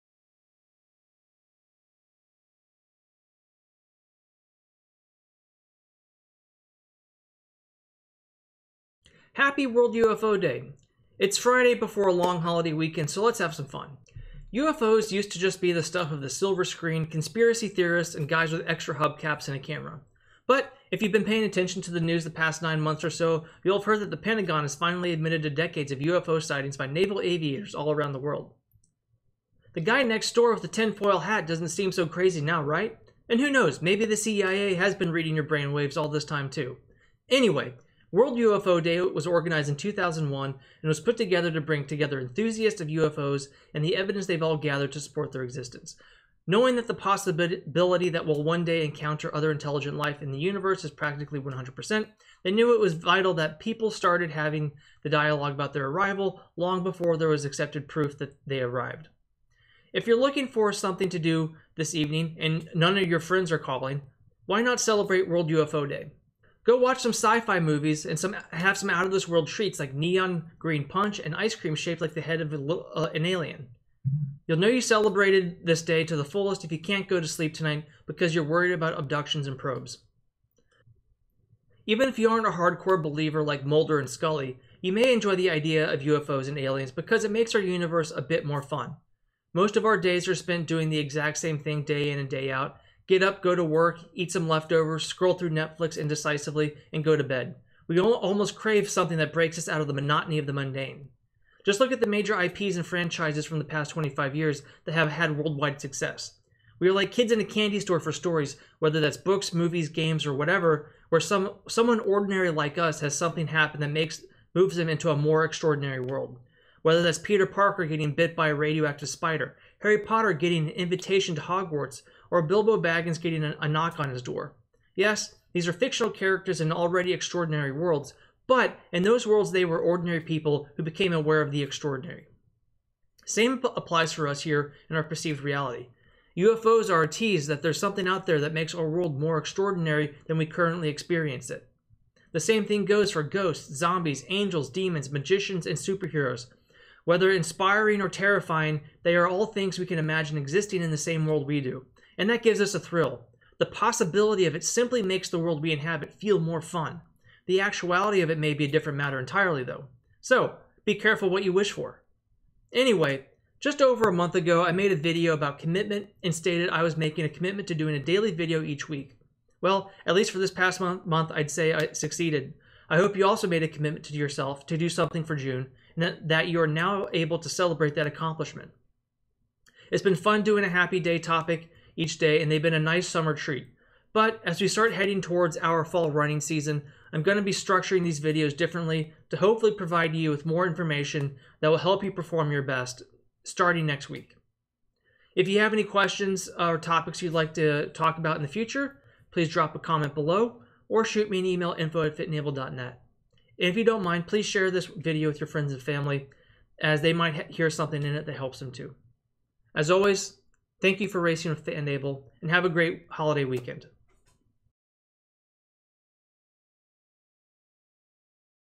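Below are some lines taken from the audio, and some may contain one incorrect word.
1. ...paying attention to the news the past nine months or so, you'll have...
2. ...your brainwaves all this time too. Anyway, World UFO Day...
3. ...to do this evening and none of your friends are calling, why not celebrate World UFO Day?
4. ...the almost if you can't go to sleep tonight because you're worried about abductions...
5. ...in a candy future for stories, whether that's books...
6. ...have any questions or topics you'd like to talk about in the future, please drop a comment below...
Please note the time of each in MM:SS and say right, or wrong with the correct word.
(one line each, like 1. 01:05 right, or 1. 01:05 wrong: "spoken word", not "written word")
1. 00:21 right
2. 00:35 right
3. 01:01 right
4. 01:16 wrong: "fullest", not "almost"
5. 01:47 wrong: "store", not "future"
6. 03:15 right.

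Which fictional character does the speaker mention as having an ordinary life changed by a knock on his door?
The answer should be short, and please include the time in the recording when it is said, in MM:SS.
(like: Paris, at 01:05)
Bilbo Baggins, at 02:02.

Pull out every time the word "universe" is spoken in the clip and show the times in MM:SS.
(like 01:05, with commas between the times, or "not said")
00:50, 01:27.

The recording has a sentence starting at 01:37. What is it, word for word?
We almost crave something that breaks us out of the monotony of the mundane.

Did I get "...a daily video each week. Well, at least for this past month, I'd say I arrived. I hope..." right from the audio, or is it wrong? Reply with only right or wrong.
wrong.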